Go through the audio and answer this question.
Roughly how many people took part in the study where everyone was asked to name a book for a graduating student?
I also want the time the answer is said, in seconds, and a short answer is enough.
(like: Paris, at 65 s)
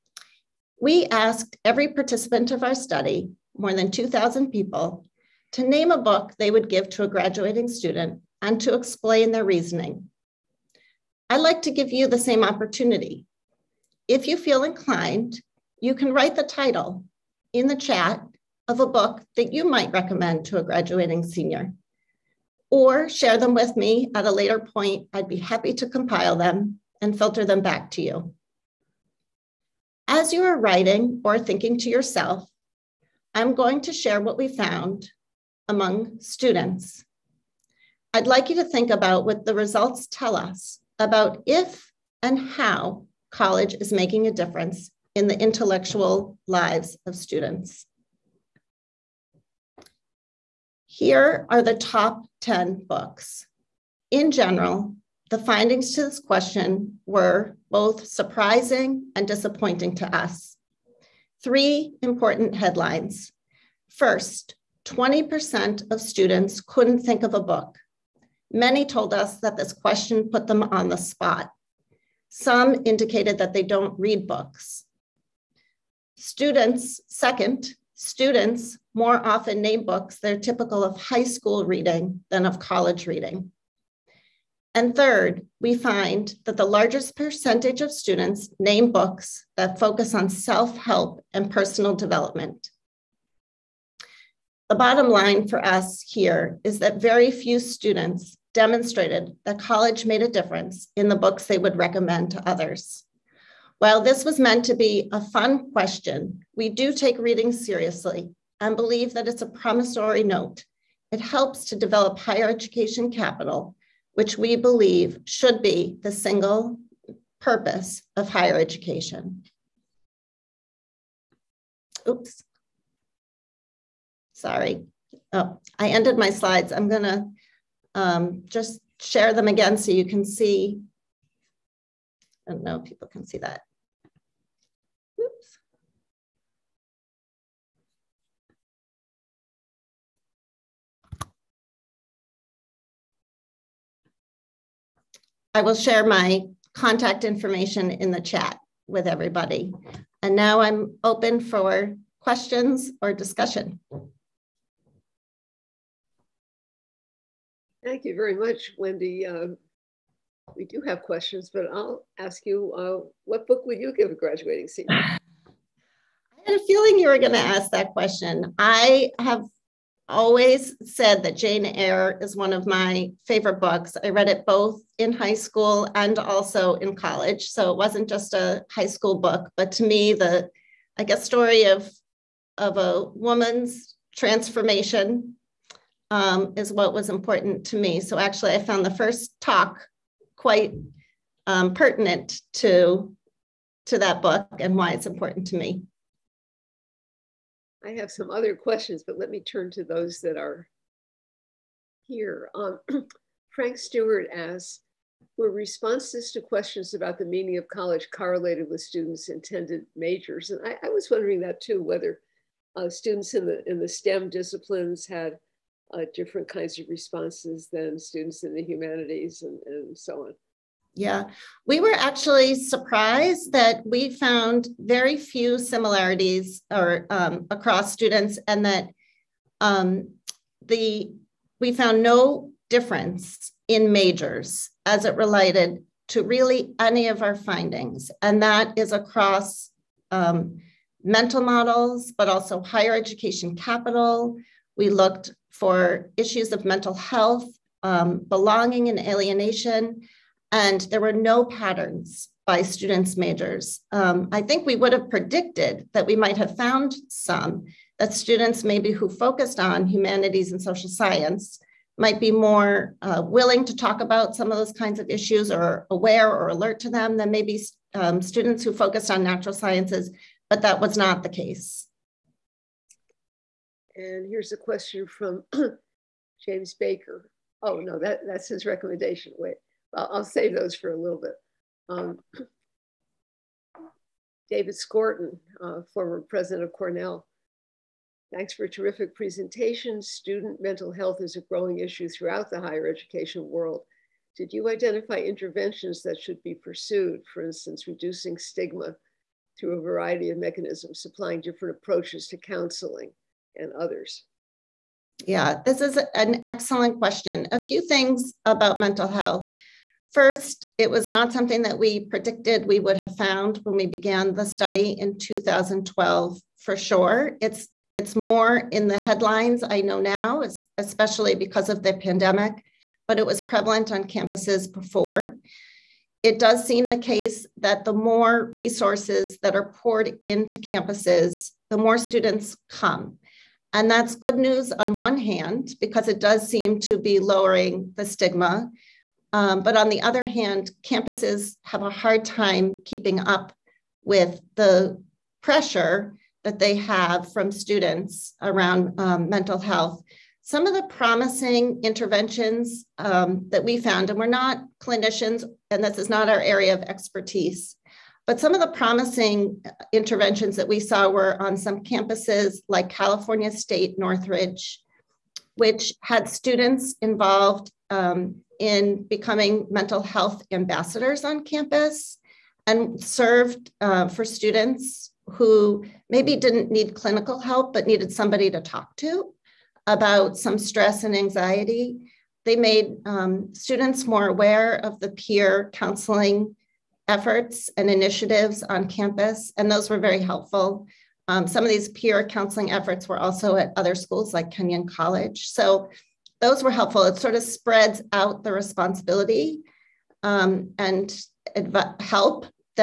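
more than 2,000, at 3 s.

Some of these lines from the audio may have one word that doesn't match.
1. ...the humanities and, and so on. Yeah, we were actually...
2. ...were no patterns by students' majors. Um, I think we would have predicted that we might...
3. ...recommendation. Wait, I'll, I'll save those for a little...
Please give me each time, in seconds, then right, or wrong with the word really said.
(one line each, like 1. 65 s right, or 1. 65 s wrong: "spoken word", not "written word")
1. 218 s right
2. 251 s right
3. 278 s right.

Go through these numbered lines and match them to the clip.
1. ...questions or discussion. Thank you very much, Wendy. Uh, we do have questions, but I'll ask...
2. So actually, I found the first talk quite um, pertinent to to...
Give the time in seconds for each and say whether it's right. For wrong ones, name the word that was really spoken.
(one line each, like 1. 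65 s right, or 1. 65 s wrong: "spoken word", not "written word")
1. 152 s right
2. 188 s right.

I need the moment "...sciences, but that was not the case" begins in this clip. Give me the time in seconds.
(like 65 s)
269 s.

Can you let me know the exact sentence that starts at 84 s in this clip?
And third, we find that the largest percentage of students name books that focus on self help and personal development.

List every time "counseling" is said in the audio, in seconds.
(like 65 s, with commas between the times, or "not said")
302 s, 385 s, 392 s.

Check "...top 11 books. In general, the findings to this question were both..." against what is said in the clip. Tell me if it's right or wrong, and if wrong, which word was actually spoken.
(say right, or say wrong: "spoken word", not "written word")
wrong: "10", not "11".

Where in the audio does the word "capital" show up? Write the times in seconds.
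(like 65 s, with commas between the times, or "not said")
113 s, 243 s.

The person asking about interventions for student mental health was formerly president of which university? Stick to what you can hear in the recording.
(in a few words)
Cornell.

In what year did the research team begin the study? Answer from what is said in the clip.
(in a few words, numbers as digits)
2012.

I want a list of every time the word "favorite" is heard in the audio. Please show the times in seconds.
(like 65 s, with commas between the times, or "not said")
173 s.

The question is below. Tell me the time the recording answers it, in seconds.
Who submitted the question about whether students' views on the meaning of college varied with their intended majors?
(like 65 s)
203 s.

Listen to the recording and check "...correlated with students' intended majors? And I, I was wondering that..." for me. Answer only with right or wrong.
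right.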